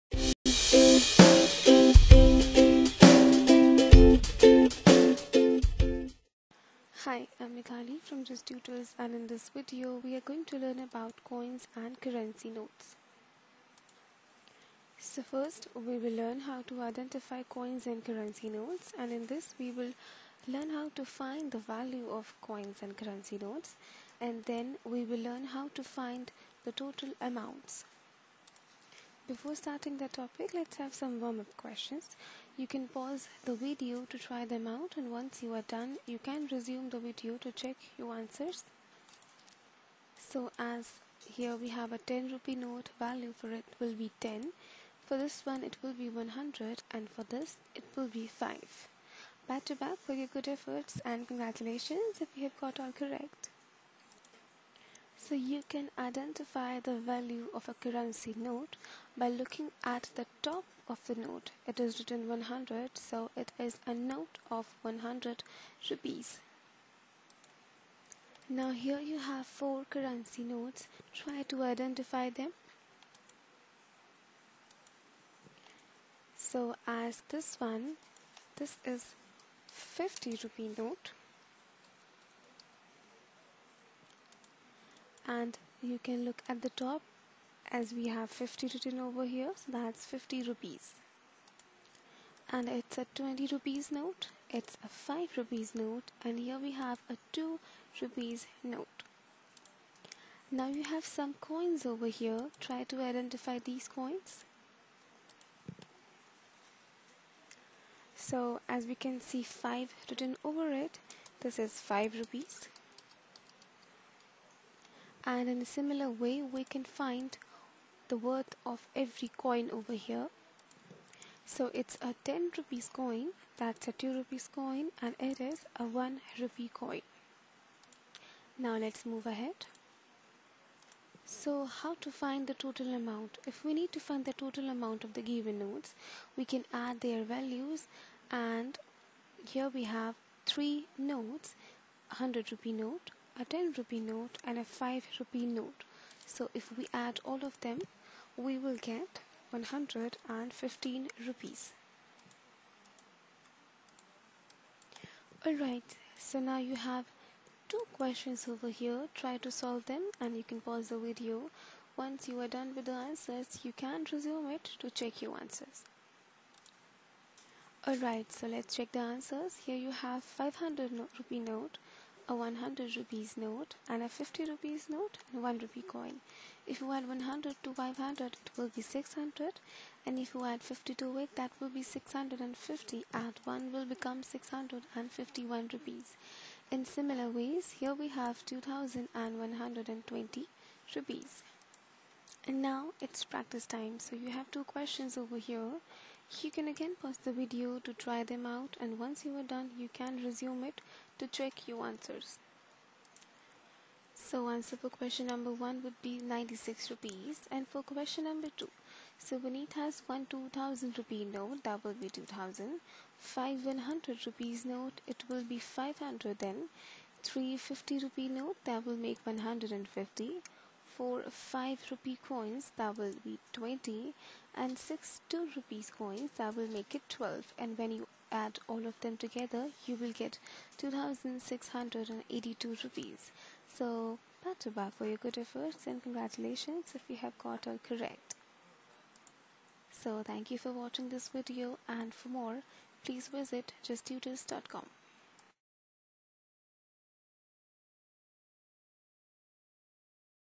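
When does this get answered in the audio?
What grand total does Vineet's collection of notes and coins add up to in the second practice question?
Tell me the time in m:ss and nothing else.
3:50.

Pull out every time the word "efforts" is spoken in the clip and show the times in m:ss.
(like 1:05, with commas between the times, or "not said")
0:50, 3:55.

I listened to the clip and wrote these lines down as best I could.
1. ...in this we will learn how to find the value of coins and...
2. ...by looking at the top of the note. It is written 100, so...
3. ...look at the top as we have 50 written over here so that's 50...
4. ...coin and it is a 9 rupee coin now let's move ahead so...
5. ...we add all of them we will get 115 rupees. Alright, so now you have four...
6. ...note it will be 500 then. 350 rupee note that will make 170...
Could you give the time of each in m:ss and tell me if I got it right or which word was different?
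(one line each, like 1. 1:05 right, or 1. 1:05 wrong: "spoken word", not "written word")
1. 0:19 right
2. 0:59 right
3. 1:26 right
4. 2:04 wrong: "1", not "9"
5. 2:26 wrong: "two", not "four"
6. 3:34 wrong: "150", not "170".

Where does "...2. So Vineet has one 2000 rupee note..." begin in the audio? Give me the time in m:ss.
3:28.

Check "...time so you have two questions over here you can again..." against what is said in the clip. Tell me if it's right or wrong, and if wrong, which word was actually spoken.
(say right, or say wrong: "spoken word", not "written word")
right.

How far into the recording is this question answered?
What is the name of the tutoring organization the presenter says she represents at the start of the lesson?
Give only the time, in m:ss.
0:08.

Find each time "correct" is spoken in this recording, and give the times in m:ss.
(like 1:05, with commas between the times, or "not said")
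0:52, 3:57.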